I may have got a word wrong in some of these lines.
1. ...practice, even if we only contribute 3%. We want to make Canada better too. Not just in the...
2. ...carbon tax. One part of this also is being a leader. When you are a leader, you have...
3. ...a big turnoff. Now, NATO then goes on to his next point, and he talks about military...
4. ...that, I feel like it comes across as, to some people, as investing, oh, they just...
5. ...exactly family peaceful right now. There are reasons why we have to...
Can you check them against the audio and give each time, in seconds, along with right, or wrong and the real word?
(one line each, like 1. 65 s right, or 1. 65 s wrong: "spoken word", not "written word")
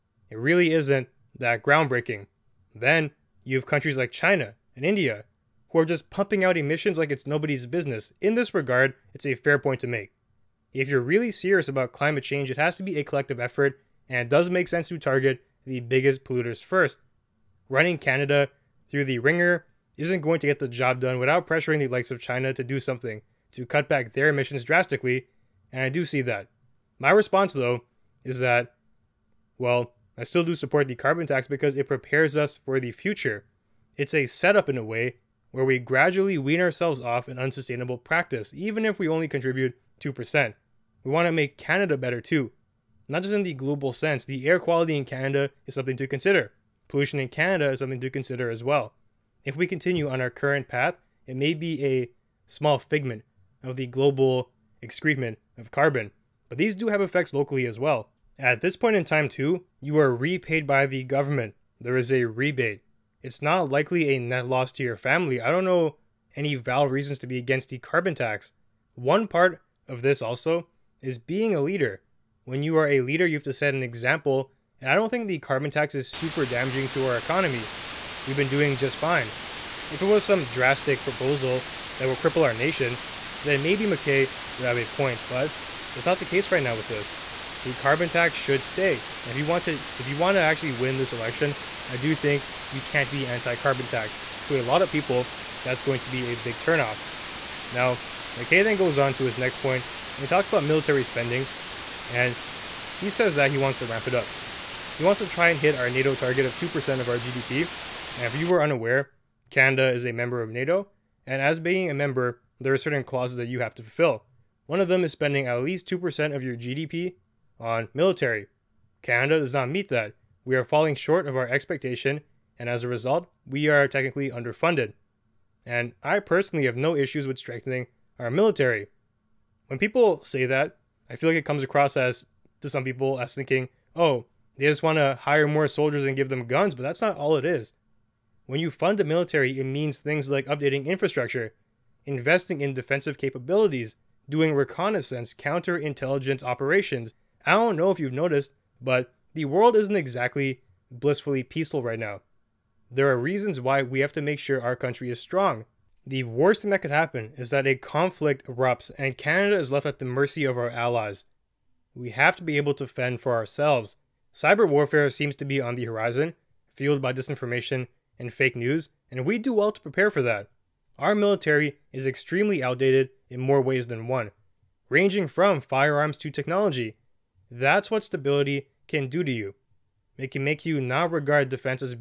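1. 37 s wrong: "2", not "3"
2. 67 s right
3. 96 s wrong: "MacKay", not "NATO"
4. 130 s wrong: "thinking", not "investing"
5. 149 s wrong: "blissfully", not "family".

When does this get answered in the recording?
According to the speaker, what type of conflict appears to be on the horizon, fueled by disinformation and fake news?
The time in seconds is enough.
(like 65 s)
164 s.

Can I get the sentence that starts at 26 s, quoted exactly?
My response, though, is that, well, I still do support the carbon tax because it prepares us for the future.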